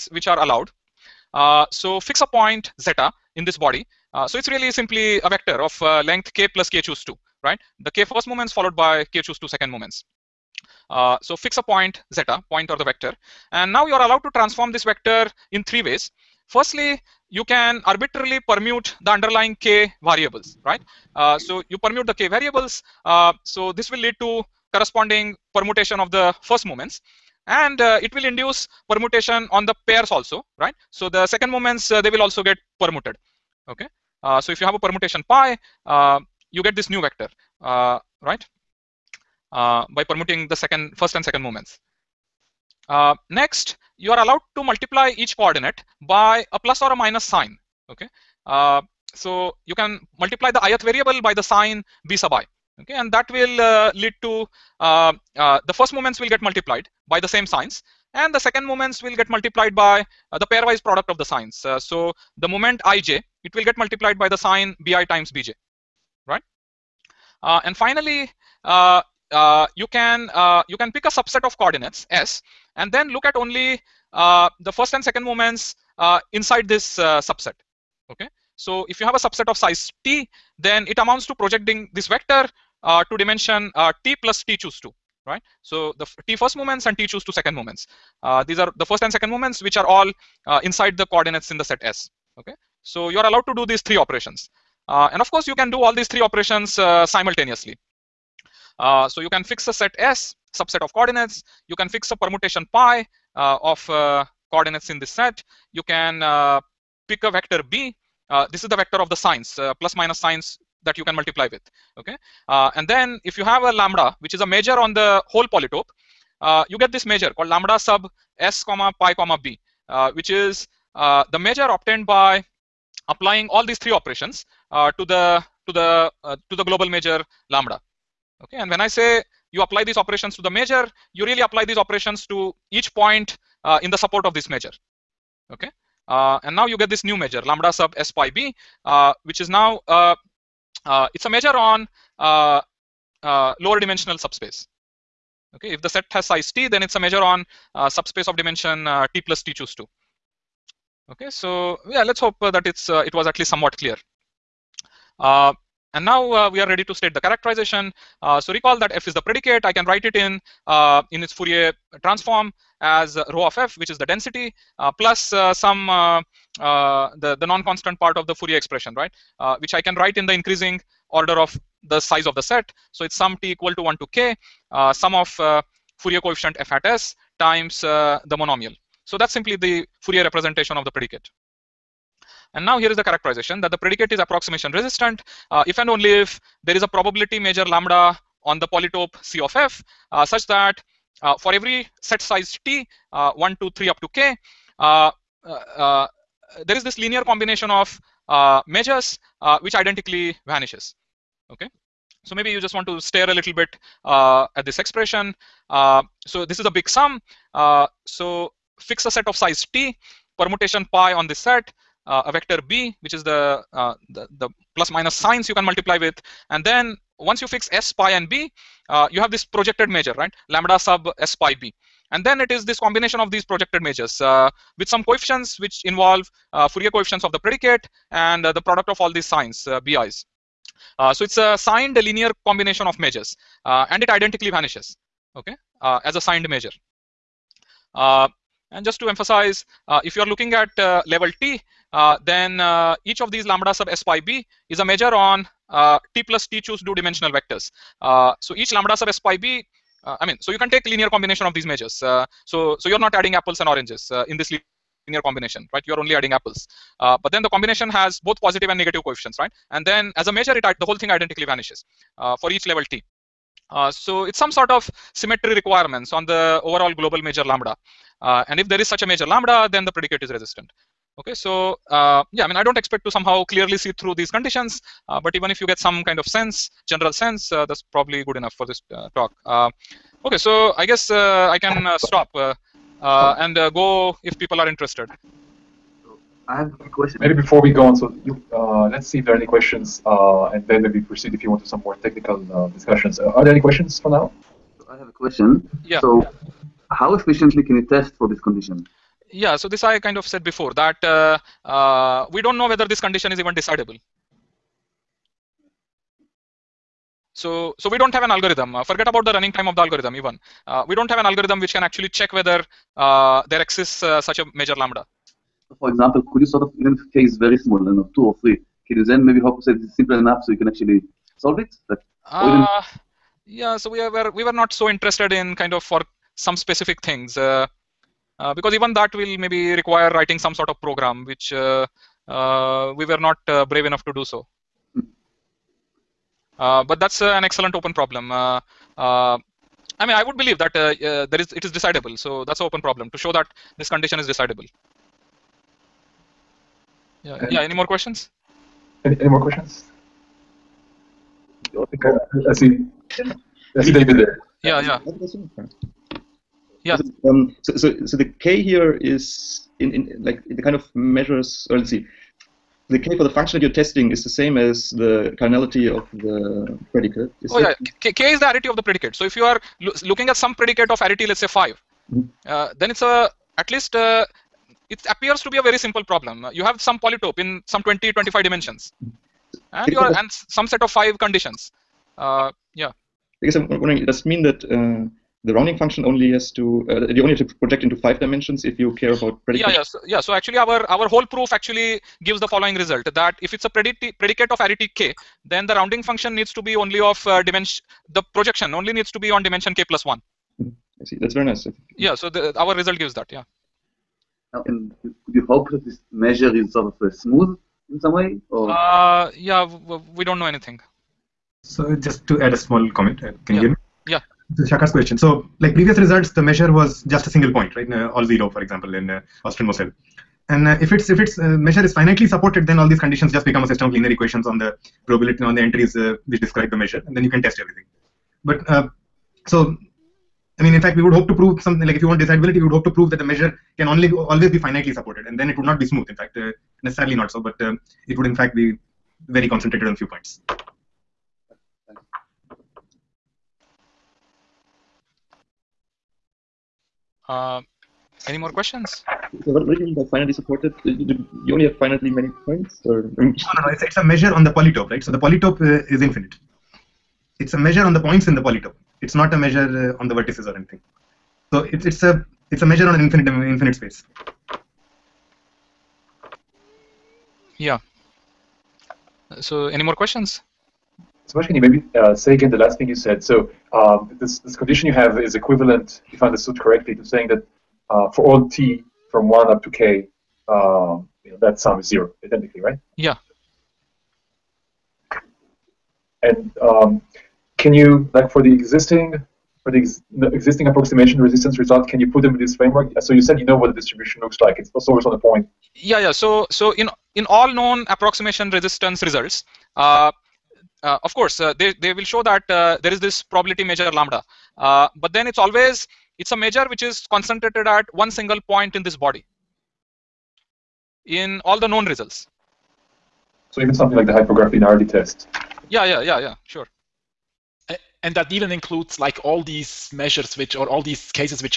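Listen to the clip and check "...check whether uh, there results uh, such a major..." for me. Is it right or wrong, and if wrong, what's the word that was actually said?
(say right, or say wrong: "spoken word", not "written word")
wrong: "exists", not "results".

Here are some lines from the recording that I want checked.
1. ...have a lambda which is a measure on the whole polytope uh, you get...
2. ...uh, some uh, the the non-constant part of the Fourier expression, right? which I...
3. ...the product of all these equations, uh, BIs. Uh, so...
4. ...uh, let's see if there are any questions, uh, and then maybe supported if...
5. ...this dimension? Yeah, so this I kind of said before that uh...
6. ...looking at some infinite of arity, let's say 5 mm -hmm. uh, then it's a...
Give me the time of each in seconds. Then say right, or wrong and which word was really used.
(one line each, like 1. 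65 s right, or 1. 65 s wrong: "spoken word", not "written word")
1. 113 s right
2. 165 s right
3. 228 s wrong: "signs", not "equations"
4. 288 s wrong: "proceed", not "supported"
5. 298 s wrong: "condition", not "dimension"
6. 370 s wrong: "predicate", not "infinite".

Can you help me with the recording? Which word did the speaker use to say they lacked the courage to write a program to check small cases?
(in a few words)
brave.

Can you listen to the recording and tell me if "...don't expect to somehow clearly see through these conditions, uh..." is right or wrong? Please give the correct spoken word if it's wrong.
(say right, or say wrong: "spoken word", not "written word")
right.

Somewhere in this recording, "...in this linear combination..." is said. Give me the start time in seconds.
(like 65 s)
254 s.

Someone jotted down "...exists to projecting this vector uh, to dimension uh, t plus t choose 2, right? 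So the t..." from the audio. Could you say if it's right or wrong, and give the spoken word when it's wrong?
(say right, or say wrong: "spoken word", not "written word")
wrong: "amounts", not "exists".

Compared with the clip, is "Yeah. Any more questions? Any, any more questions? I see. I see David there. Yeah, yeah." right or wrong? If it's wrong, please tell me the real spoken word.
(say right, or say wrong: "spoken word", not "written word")
right.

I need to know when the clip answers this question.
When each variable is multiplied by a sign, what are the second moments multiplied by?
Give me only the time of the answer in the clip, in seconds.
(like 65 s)
60 s.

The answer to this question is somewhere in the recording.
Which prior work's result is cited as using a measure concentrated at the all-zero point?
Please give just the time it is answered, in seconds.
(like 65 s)
419 s.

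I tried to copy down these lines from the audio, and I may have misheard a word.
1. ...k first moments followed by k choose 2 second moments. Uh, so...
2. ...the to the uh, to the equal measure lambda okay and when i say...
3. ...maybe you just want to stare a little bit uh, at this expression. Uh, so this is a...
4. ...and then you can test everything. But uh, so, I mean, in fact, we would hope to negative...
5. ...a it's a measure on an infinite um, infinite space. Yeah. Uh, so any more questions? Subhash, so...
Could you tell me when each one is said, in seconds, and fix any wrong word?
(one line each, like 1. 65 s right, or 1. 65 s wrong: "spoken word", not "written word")
1. 7 s right
2. 125 s wrong: "global", not "equal"
3. 202 s right
4. 427 s wrong: "prove", not "negative"
5. 462 s right.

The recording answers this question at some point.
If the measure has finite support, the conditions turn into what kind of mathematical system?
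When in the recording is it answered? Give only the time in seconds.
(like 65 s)
423 s.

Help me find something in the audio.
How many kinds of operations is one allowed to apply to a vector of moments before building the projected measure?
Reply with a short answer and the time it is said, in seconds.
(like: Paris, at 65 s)
3, at 15 s.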